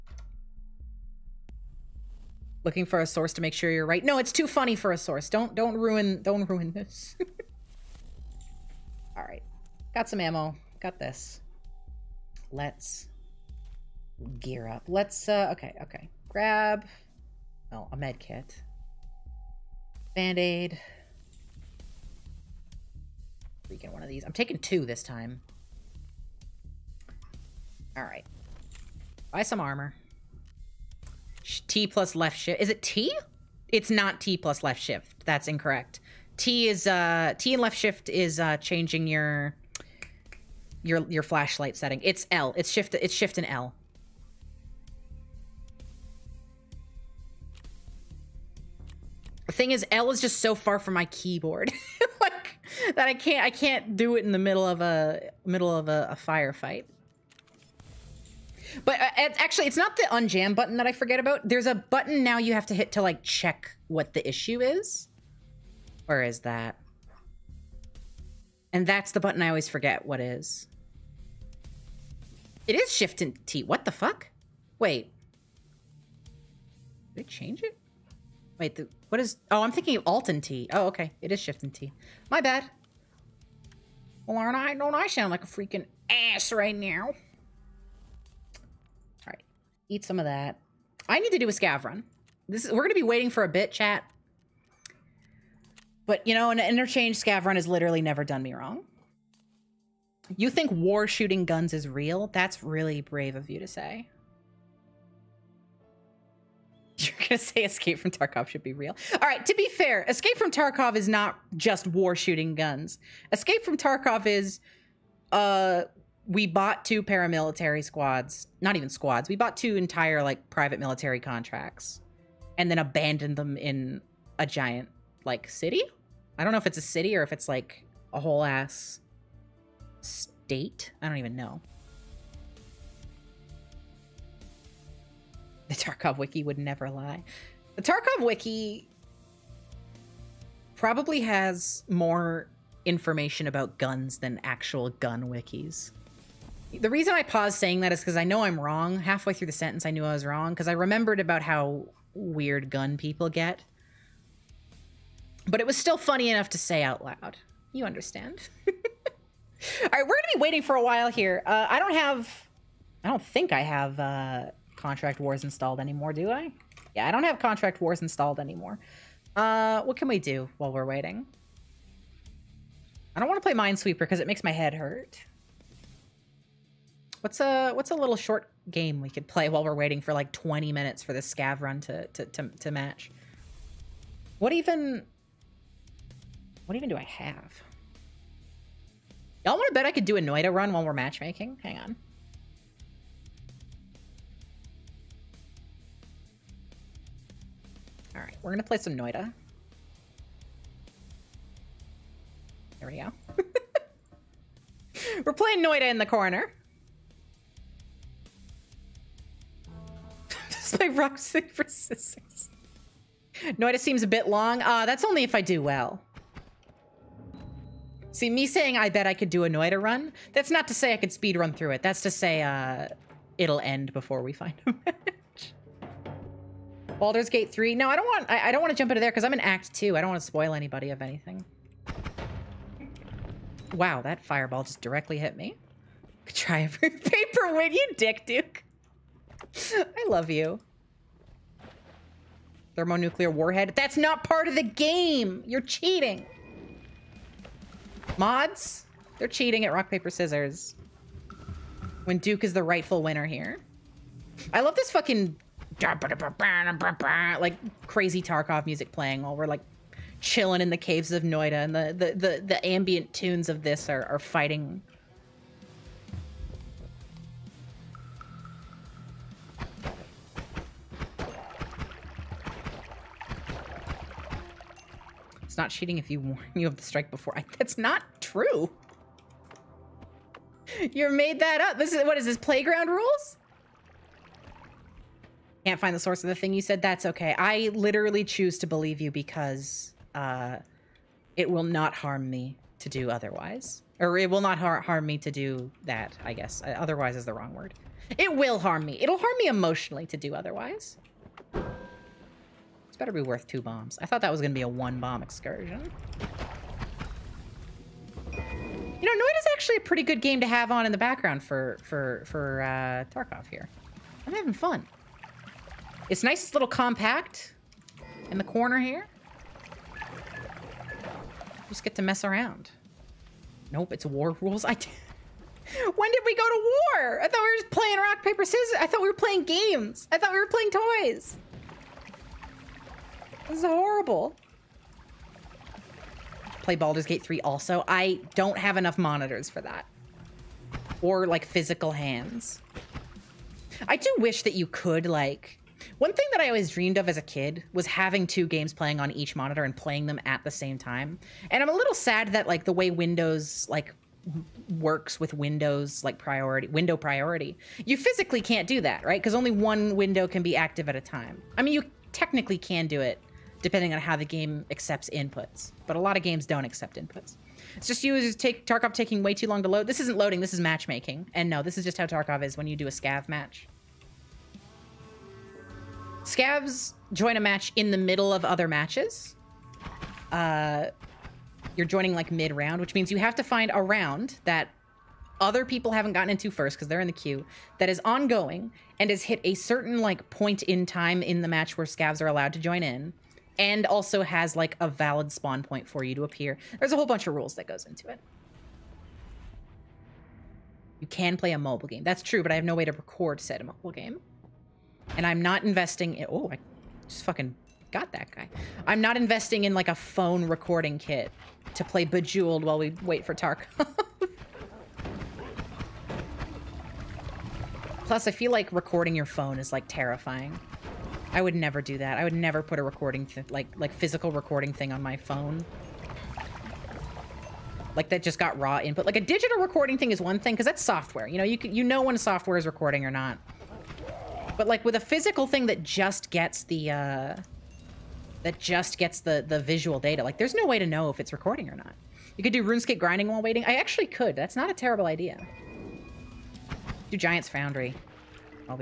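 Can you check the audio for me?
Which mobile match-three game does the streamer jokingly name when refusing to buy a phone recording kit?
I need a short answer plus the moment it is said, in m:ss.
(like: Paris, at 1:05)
Bejeweled, at 6:52.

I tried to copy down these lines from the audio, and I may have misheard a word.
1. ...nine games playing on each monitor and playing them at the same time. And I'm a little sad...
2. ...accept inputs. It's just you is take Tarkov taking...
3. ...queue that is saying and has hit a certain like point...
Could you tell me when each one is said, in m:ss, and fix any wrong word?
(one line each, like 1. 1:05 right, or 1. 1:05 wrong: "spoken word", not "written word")
1. 5:48 wrong: "two", not "nine"
2. 6:06 right
3. 6:27 wrong: "ongoing", not "saying".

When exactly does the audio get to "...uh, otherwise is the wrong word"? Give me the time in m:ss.
4:56.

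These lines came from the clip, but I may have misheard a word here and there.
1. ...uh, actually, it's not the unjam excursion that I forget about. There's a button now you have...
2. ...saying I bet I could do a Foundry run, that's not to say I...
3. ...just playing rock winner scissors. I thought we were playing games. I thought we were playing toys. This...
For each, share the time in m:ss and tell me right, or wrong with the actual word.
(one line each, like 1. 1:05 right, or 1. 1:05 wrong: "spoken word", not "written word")
1. 0:58 wrong: "button", not "excursion"
2. 3:38 wrong: "Noita", not "Foundry"
3. 5:27 wrong: "paper", not "winner".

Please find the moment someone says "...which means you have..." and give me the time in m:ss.
6:22.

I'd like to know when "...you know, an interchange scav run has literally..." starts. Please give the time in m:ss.
1:36.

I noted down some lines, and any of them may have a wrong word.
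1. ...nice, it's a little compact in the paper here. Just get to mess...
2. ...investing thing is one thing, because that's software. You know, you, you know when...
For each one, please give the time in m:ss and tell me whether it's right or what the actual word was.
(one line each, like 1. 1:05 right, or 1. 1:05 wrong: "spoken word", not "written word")
1. 5:16 wrong: "corner", not "paper"
2. 7:09 wrong: "recording", not "investing".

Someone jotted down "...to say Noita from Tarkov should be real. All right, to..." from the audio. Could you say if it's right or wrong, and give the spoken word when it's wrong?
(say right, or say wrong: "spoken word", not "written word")
wrong: "Escape", not "Noita".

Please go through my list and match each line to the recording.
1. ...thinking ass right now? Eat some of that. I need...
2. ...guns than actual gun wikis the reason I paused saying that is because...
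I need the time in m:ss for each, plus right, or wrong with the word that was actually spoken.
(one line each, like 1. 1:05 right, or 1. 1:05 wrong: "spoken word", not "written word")
1. 1:25 wrong: "freaking", not "thinking"
2. 2:23 right.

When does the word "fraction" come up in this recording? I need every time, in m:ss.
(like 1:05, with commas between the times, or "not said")
not said.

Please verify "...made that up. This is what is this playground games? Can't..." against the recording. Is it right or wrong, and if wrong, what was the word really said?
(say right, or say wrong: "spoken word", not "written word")
wrong: "rules", not "games".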